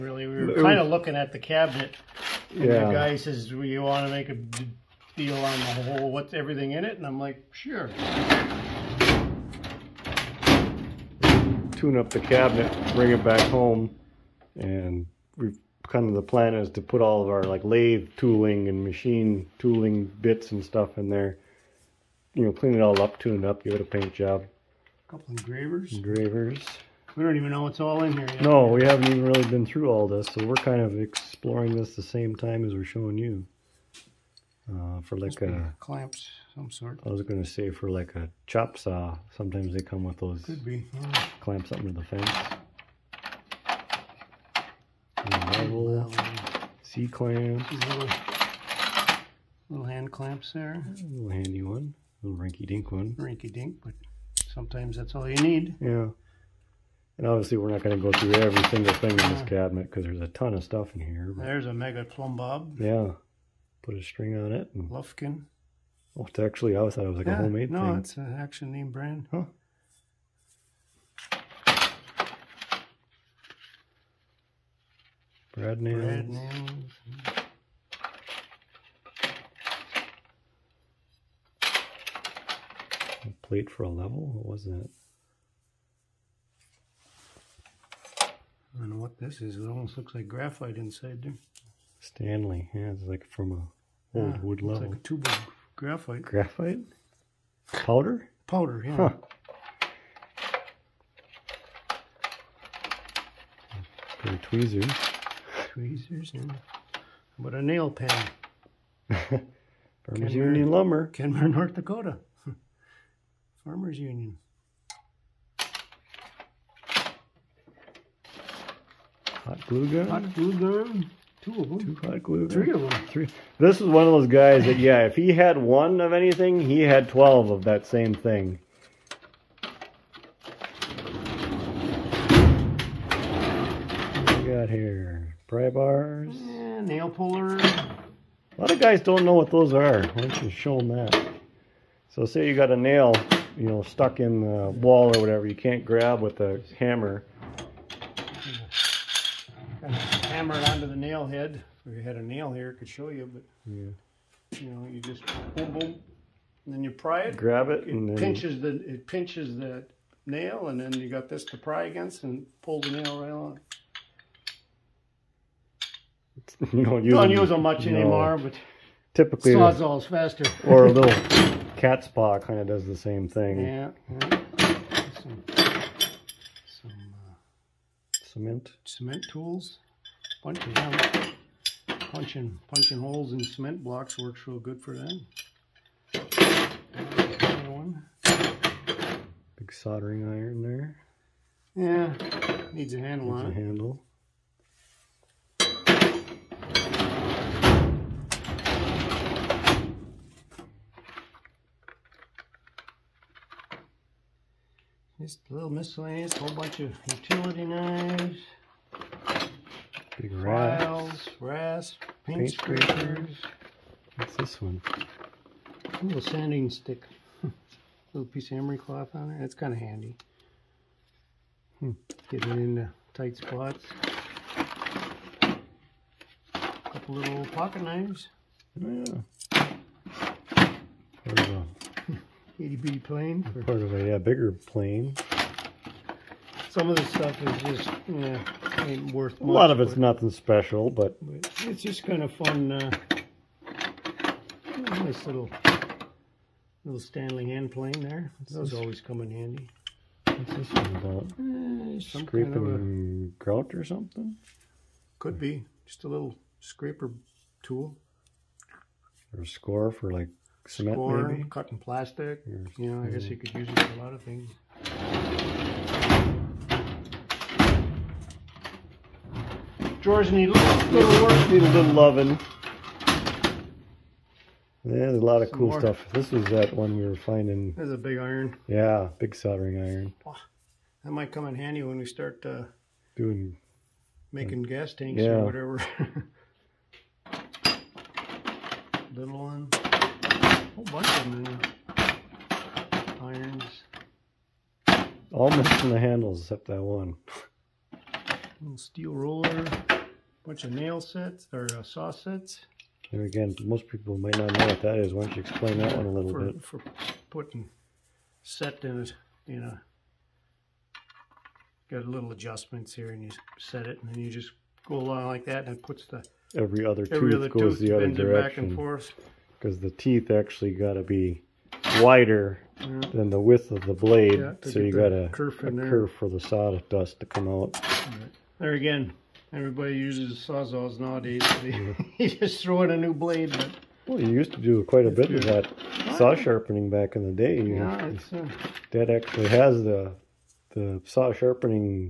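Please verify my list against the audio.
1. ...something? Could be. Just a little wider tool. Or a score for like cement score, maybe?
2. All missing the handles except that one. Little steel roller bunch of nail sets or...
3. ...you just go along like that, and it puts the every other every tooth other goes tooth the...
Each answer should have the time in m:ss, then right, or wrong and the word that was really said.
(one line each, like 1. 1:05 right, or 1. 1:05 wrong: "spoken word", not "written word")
1. 4:13 wrong: "scraper", not "wider"
2. 4:55 right
3. 5:14 right.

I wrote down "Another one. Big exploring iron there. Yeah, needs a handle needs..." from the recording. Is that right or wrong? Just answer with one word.
wrong.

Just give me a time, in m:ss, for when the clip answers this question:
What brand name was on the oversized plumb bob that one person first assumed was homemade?
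1:04.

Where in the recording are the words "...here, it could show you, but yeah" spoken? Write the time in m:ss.
2:32.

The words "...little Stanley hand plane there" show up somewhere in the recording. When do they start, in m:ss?
4:06.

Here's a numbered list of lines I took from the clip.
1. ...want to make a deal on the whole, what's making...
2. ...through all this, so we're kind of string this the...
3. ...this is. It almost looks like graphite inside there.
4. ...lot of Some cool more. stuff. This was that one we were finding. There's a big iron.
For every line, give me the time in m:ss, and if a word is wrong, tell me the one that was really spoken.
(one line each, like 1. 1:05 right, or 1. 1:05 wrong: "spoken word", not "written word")
1. 0:03 wrong: "everything", not "making"
2. 0:29 wrong: "exploring", not "string"
3. 1:29 right
4. 4:35 right.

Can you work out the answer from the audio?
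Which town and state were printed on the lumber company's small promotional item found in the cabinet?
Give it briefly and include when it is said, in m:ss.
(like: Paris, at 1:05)
Kenmore, North Dakota, at 1:51.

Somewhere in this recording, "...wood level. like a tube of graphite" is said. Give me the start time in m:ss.
1:34.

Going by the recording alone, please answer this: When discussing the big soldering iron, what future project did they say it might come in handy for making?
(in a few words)
gas tanks.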